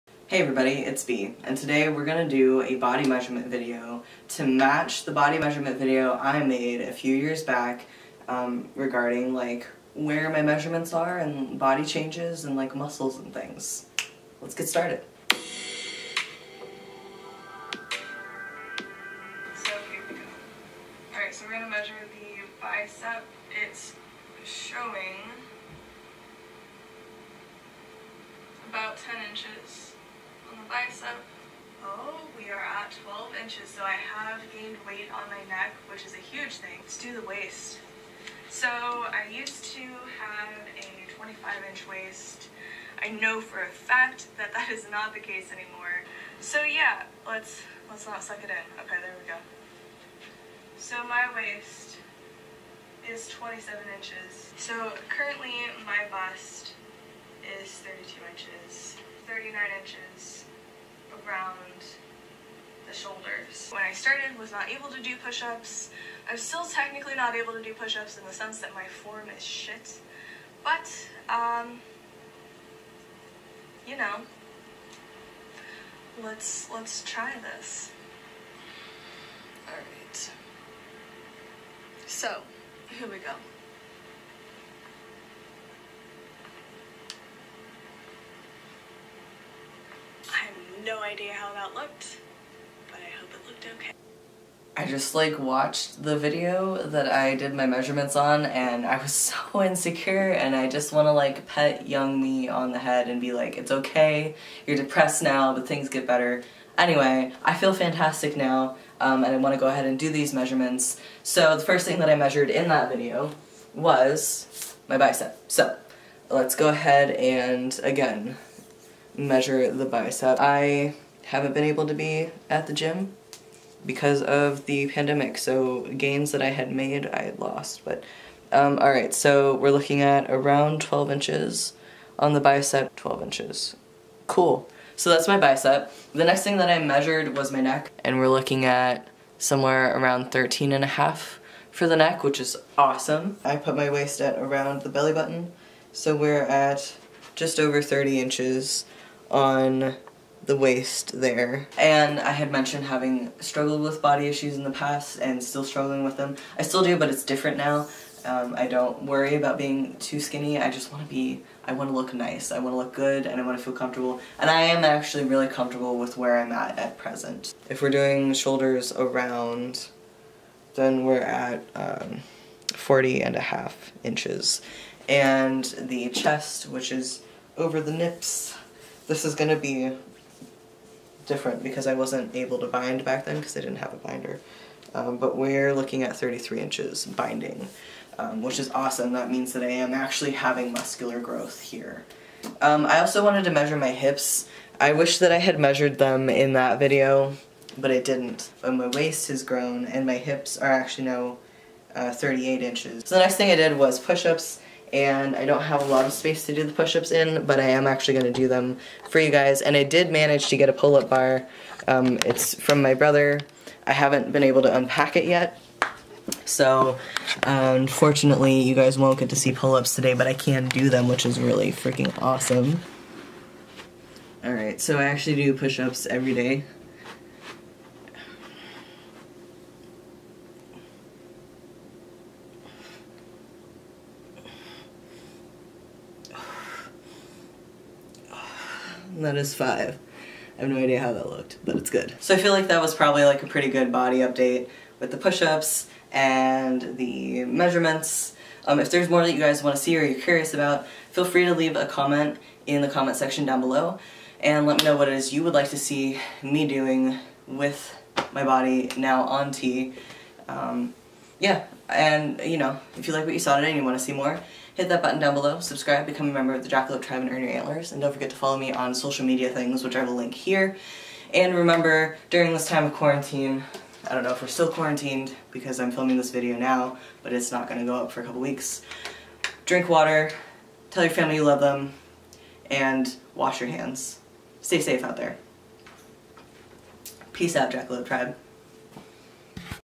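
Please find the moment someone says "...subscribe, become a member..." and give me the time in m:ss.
4:25.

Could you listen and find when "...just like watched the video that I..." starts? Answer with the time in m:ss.
1:34.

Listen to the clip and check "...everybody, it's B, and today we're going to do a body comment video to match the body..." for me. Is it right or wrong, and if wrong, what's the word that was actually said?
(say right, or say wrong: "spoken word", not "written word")
wrong: "measurement", not "comment".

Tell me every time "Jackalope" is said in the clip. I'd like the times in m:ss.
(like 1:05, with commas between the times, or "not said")
4:26, 4:47.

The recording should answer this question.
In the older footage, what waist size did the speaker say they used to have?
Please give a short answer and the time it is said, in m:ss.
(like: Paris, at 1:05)
25 inches, at 0:41.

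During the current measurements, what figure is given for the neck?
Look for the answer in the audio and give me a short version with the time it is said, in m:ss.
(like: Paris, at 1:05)
13 and a half, at 2:20.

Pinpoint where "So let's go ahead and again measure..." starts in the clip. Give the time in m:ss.
1:55.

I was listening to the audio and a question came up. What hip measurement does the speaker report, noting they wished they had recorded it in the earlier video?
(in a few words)
38 inches.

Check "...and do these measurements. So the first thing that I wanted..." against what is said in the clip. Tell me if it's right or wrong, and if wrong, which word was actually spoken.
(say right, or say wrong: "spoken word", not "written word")
wrong: "measured", not "wanted".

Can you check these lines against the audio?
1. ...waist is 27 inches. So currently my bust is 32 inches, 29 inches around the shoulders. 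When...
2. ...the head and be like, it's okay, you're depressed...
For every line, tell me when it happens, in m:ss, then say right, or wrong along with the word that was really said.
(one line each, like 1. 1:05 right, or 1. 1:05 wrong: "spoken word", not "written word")
1. 0:51 wrong: "39", not "29"
2. 1:42 right.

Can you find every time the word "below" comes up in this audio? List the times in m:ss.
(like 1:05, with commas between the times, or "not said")
4:13, 4:25.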